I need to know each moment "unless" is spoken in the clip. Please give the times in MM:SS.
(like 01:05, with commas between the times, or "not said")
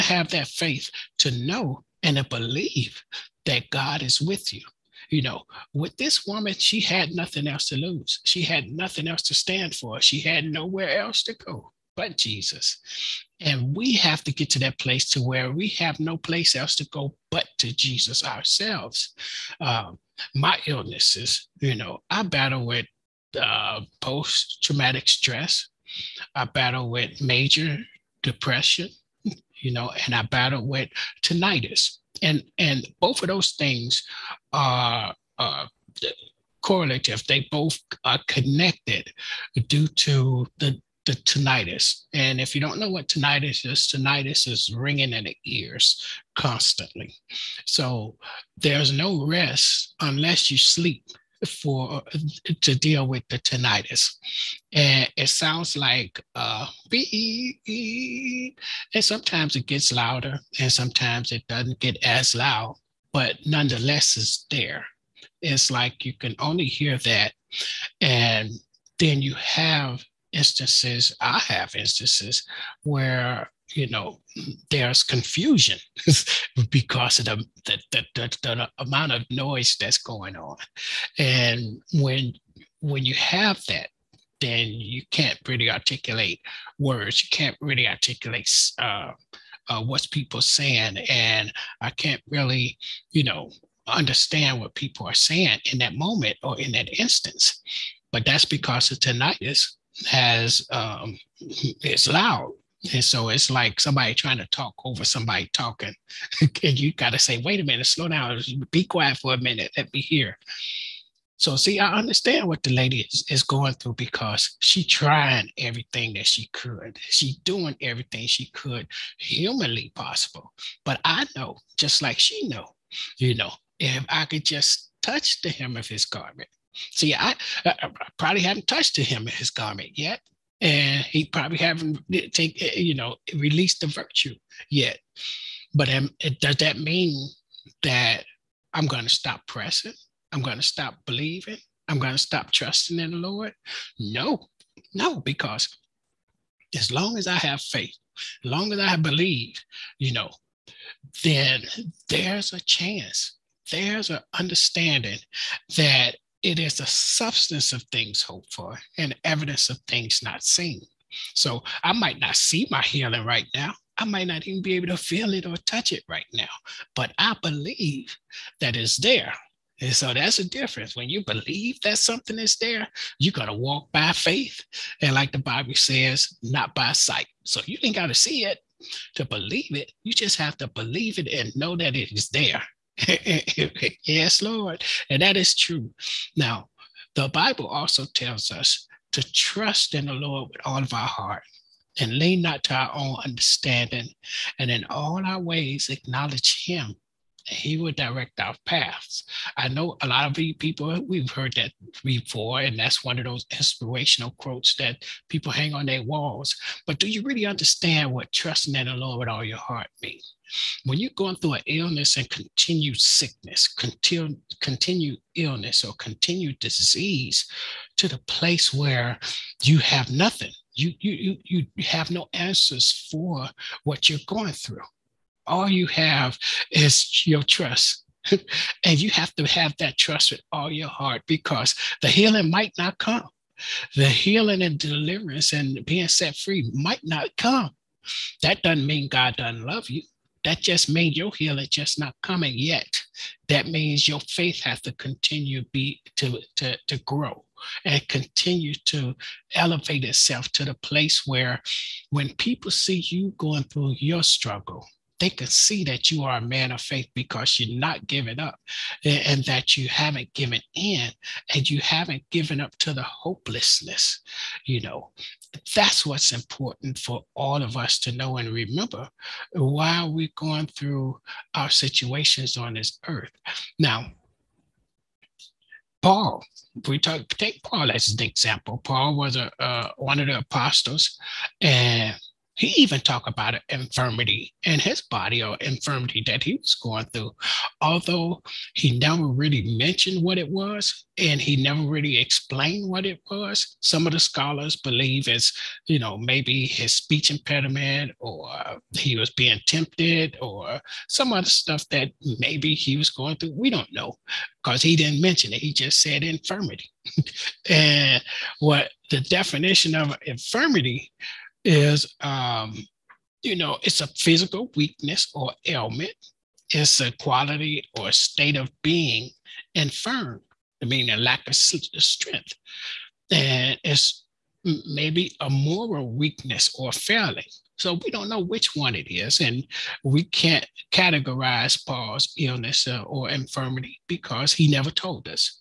00:49.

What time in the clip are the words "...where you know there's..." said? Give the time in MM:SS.
01:12.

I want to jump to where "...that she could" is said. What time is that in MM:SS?
01:56.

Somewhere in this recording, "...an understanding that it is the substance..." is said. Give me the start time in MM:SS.
02:34.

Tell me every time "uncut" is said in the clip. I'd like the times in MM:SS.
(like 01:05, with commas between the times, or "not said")
not said.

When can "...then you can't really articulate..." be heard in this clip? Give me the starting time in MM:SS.
01:24.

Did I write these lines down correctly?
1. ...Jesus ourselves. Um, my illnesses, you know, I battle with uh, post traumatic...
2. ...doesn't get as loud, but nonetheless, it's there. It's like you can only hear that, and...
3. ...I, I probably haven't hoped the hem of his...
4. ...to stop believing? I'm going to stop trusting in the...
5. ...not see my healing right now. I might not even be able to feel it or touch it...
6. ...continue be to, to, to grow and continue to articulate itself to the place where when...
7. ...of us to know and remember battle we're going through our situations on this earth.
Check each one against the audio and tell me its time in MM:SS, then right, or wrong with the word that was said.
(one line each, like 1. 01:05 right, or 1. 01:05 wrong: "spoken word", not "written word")
1. 00:17 right
2. 01:01 right
3. 02:07 wrong: "touched", not "hoped"
4. 02:20 right
5. 02:42 right
6. 04:04 wrong: "elevate", not "articulate"
7. 04:27 wrong: "while", not "battle".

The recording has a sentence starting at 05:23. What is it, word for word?
And it's maybe a moral weakness or failing.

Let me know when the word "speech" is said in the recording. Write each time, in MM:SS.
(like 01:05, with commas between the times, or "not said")
04:56.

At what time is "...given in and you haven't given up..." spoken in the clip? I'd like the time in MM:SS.
04:20.